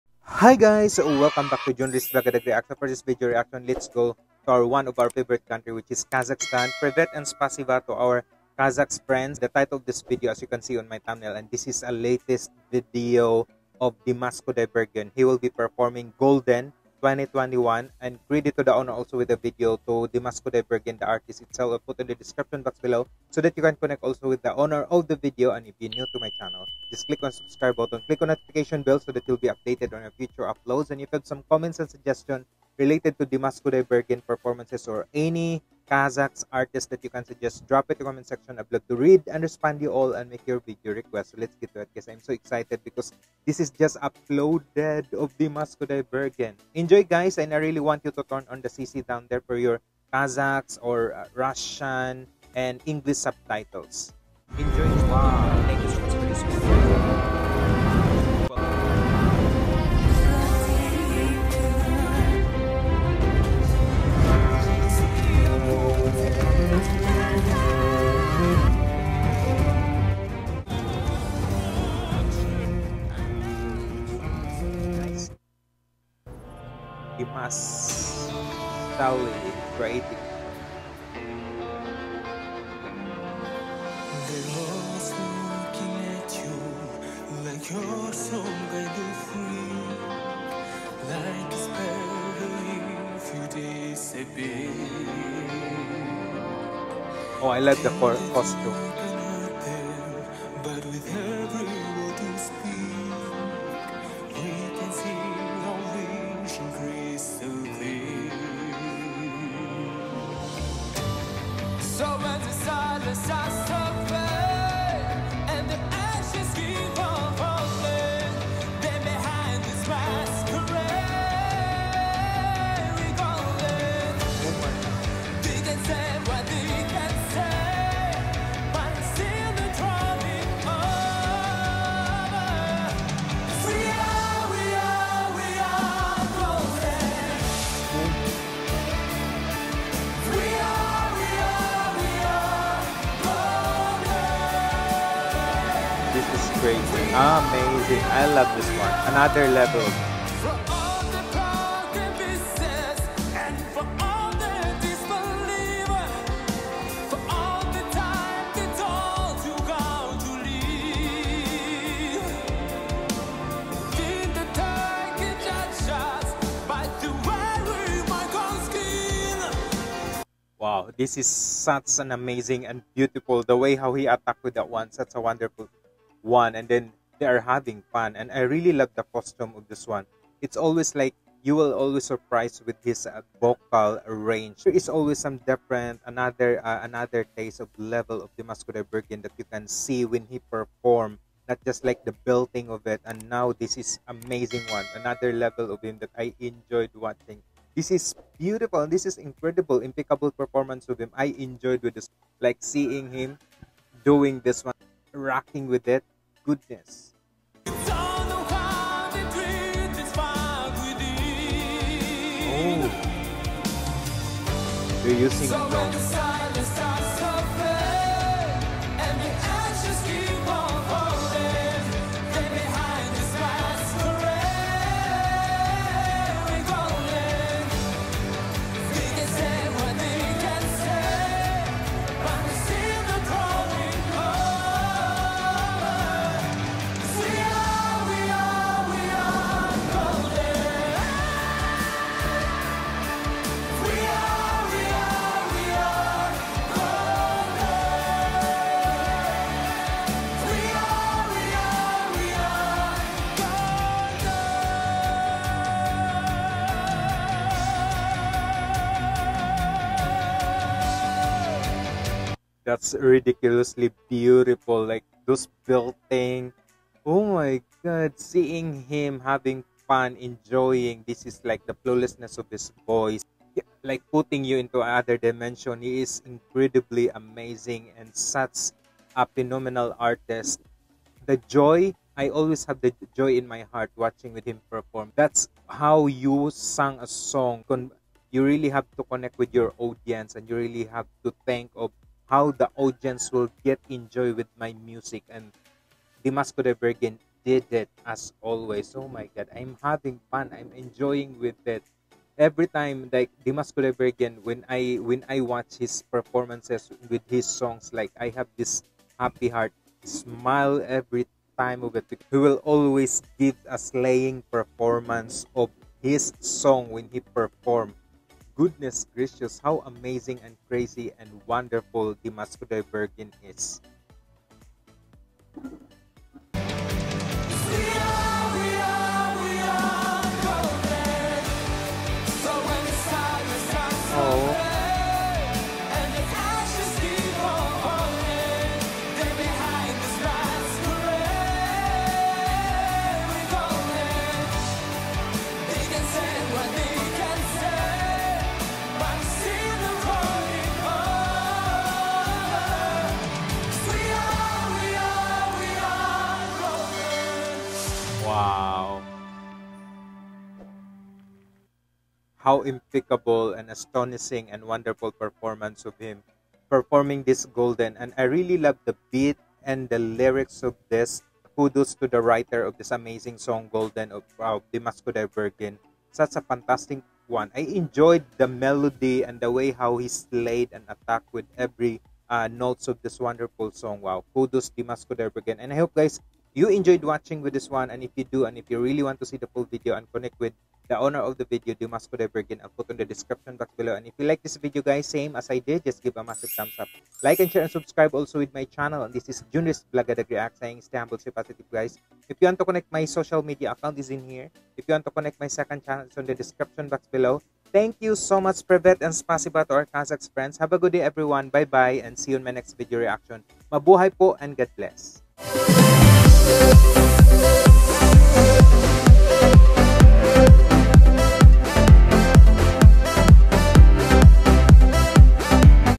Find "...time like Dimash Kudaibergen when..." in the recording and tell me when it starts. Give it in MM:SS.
05:02.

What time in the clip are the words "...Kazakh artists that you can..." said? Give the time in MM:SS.
00:35.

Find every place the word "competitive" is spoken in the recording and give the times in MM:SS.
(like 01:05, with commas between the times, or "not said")
not said.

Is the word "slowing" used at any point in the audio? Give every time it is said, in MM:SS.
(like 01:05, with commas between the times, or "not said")
not said.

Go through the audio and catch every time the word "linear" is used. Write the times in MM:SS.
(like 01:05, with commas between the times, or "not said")
not said.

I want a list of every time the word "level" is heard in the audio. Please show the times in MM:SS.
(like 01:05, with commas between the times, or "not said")
03:07, 03:15.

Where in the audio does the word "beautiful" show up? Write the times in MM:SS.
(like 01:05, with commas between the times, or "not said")
03:18, 04:24.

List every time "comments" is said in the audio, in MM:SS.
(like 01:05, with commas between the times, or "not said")
00:31, 00:38.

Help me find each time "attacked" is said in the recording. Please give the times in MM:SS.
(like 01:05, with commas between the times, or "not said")
06:20.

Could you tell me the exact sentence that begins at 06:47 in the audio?
Thank you so much, Privet and Spasibo to our Kazakh friends.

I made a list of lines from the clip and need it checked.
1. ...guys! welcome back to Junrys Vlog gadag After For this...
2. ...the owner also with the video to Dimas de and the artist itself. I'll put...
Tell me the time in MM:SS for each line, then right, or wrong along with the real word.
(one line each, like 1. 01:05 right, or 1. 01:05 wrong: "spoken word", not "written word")
1. 00:00 right
2. 00:18 right.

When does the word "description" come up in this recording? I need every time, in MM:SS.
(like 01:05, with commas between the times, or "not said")
00:22, 06:33, 06:46.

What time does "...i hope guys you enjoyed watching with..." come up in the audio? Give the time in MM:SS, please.
06:25.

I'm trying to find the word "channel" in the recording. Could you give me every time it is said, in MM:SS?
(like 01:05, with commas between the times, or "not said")
00:26, 06:38, 06:45.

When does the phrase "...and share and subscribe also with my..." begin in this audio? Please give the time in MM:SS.
06:37.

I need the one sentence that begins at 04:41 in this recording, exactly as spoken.
The joy, I always have the joy in my heart watching with him perform.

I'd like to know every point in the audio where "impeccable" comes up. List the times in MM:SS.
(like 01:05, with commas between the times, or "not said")
03:19, 06:02.